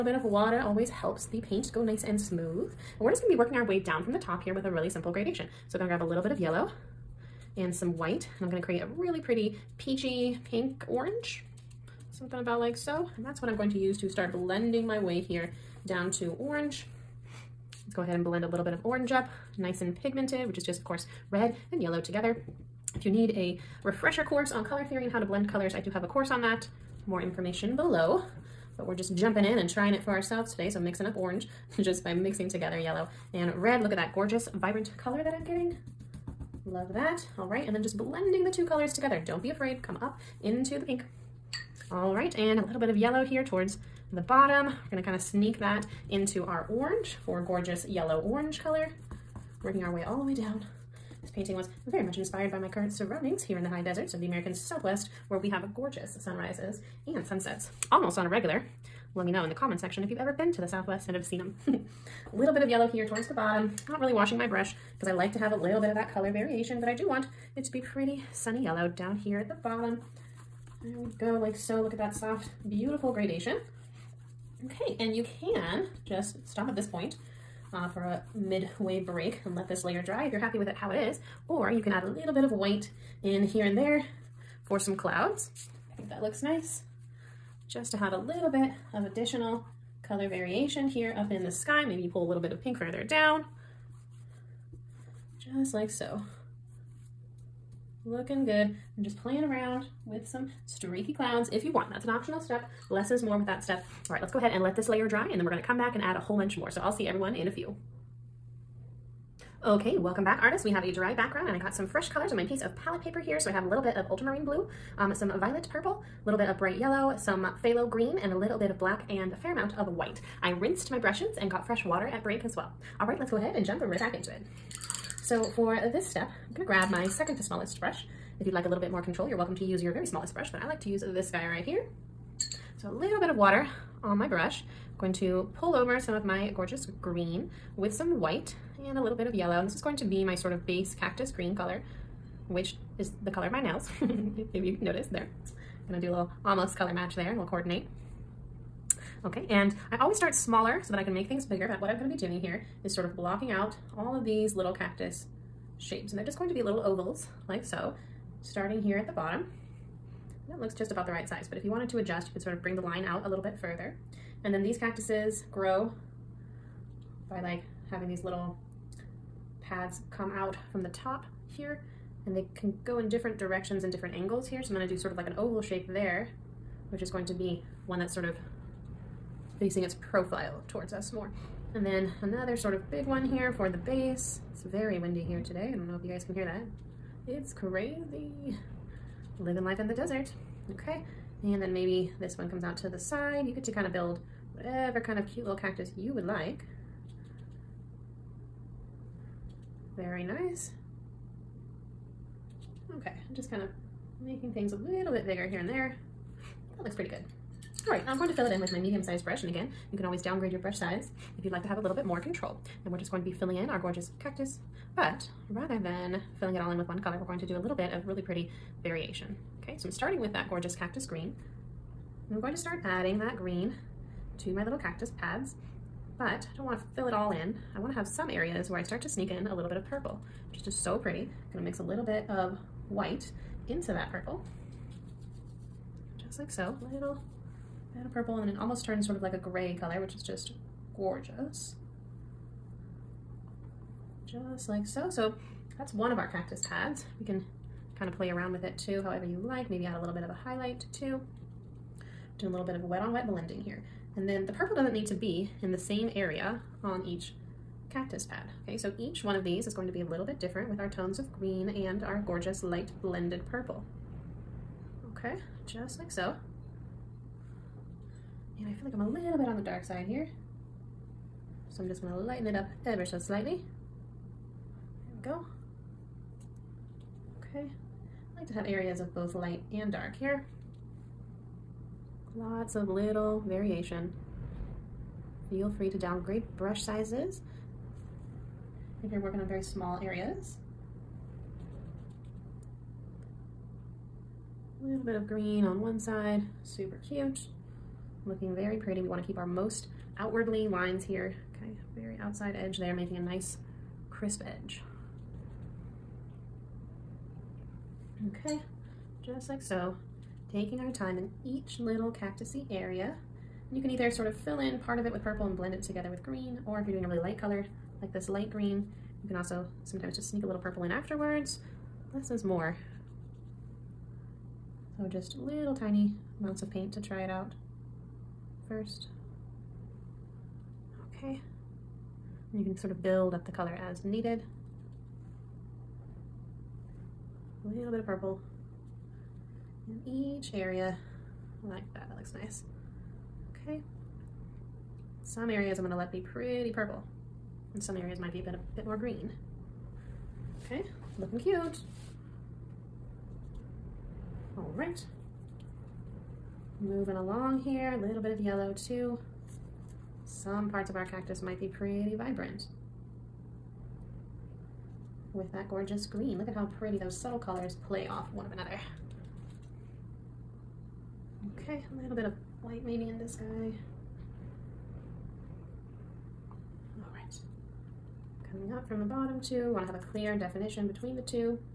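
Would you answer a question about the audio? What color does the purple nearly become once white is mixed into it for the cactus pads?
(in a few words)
gray.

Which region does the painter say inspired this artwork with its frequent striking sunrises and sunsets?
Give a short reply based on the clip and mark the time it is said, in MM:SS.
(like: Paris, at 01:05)
American Southwest, at 00:54.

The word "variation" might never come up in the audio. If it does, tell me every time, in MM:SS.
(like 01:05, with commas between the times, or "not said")
01:06, 01:30, 03:38, 04:43.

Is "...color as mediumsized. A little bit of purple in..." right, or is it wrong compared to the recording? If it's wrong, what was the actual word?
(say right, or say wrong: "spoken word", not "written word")
wrong: "needed", not "mediumsized".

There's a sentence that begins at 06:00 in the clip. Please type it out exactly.
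Some parts of our cactus might be pretty vibrant.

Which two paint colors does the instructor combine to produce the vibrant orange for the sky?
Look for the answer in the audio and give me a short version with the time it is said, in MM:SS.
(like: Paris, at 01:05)
yellow and red, at 00:32.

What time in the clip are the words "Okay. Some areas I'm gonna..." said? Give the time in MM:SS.
05:43.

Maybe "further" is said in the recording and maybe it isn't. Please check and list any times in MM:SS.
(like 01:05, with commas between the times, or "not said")
01:32, 02:43.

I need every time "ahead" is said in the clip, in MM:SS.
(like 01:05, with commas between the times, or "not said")
00:18, 01:44, 02:03.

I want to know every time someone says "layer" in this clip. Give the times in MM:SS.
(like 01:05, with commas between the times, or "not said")
01:19, 01:44.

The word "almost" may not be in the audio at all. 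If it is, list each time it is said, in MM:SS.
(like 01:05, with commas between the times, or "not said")
00:57, 02:26, 03:58.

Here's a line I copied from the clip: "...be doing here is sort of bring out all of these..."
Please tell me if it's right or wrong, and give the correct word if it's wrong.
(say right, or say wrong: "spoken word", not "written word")
wrong: "blocking", not "bring".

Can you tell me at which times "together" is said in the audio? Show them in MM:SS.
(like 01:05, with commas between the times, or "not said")
00:21, 00:32, 00:38, 05:15.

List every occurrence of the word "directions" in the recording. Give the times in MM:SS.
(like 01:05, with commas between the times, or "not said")
02:53.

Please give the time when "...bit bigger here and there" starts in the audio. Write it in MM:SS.
03:25.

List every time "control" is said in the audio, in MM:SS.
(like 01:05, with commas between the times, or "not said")
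02:09, 03:32.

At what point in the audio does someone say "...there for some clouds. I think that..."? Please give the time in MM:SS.
01:23.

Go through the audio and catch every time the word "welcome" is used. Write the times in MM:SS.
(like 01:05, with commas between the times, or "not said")
01:49, 02:09.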